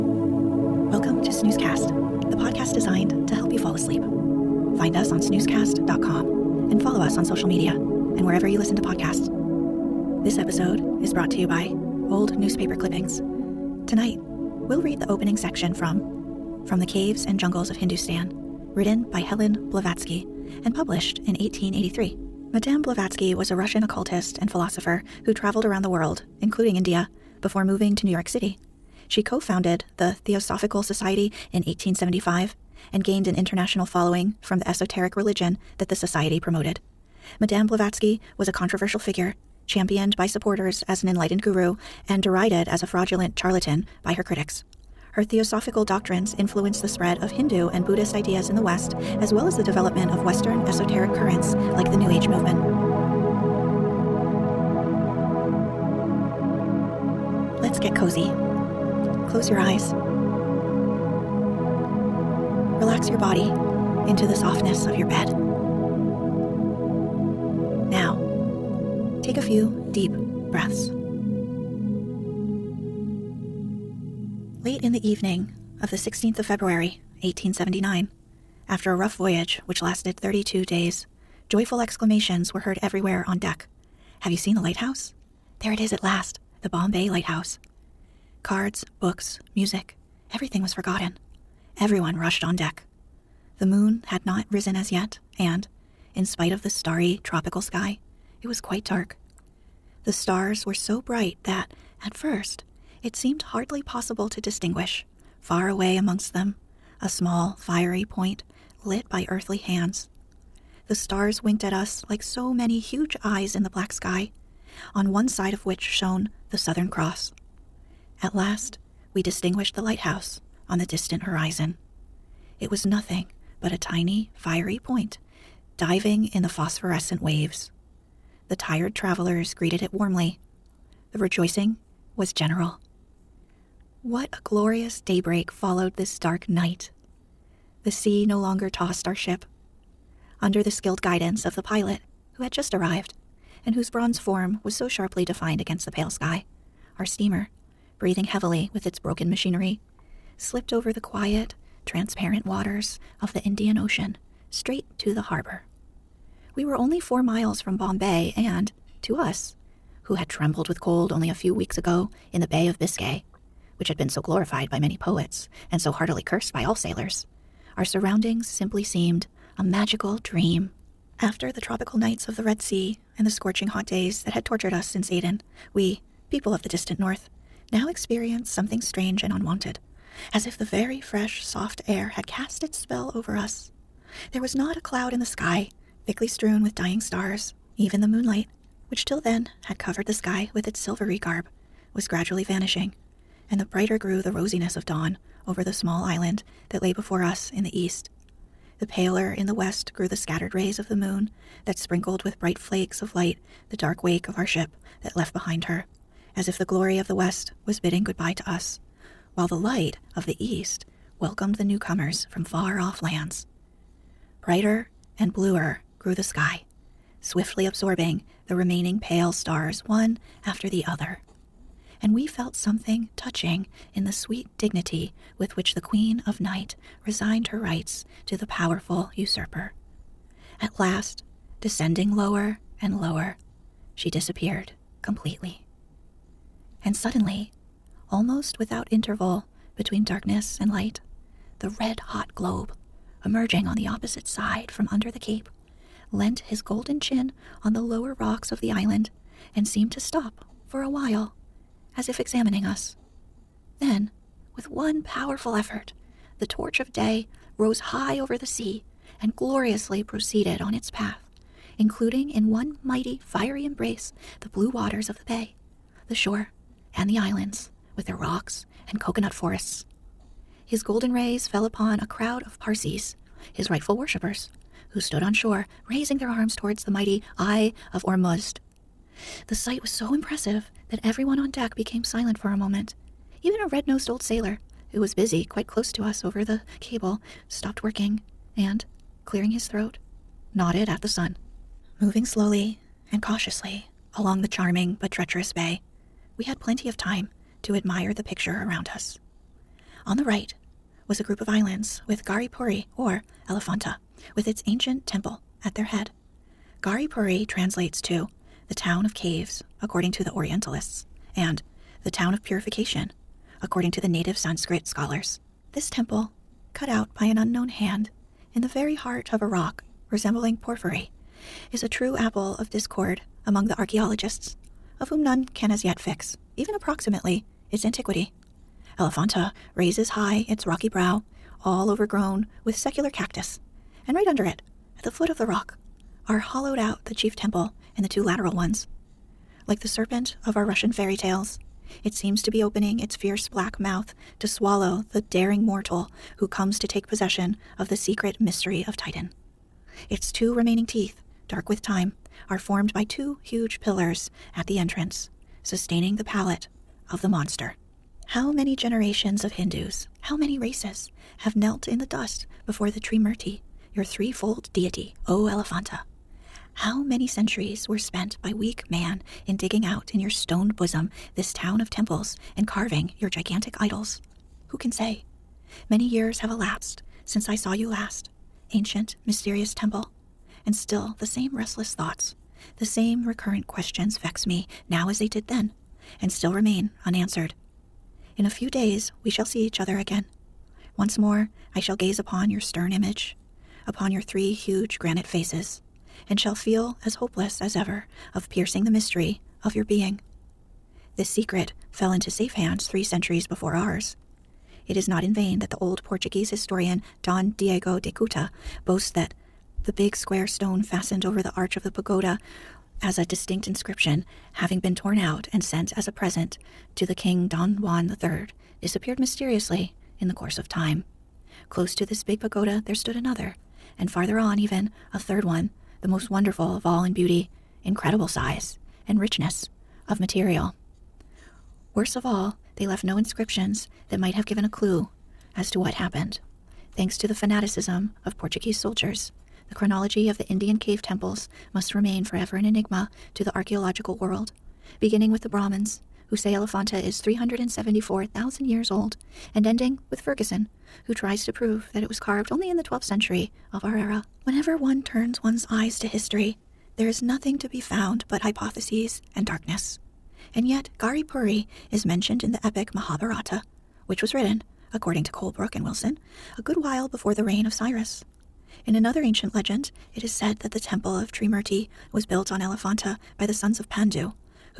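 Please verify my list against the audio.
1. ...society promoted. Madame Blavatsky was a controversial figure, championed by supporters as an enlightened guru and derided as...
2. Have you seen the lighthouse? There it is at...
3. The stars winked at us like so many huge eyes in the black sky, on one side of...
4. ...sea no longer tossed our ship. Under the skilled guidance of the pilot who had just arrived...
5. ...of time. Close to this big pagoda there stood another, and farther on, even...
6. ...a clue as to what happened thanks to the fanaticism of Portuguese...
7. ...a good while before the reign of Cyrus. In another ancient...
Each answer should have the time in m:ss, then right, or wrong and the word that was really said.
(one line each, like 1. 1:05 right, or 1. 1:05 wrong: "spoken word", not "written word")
1. 0:35 right
2. 1:24 right
3. 1:50 right
4. 2:17 right
5. 7:00 right
6. 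7:14 right
7. 7:46 right.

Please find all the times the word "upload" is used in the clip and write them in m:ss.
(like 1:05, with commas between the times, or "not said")
not said.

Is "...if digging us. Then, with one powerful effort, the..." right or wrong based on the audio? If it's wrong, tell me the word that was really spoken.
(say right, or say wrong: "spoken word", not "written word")
wrong: "examining", not "digging".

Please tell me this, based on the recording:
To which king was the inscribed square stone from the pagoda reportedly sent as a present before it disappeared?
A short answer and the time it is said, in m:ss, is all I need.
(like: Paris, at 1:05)
Don Juan III, at 6:57.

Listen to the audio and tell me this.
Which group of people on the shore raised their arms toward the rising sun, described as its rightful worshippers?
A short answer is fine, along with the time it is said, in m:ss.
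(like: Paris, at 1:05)
Parsees, at 4:32.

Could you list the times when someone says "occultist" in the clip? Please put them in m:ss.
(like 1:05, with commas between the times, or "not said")
0:23.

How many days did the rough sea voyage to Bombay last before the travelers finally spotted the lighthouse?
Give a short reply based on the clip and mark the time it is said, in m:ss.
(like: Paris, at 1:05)
32, at 1:20.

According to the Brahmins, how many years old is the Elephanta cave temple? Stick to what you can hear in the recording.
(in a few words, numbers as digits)
374,000.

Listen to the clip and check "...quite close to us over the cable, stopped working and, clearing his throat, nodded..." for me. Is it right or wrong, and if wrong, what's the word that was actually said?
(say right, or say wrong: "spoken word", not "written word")
right.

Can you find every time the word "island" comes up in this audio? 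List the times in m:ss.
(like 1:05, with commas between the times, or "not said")
3:16, 4:08, 4:27, 5:01.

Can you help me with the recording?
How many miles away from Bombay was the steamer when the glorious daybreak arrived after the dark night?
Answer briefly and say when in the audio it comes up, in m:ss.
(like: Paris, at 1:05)
4, at 2:36.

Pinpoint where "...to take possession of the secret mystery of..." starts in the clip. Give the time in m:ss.
5:46.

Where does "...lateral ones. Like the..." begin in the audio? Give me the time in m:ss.
5:38.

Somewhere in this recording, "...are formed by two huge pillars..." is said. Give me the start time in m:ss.
5:52.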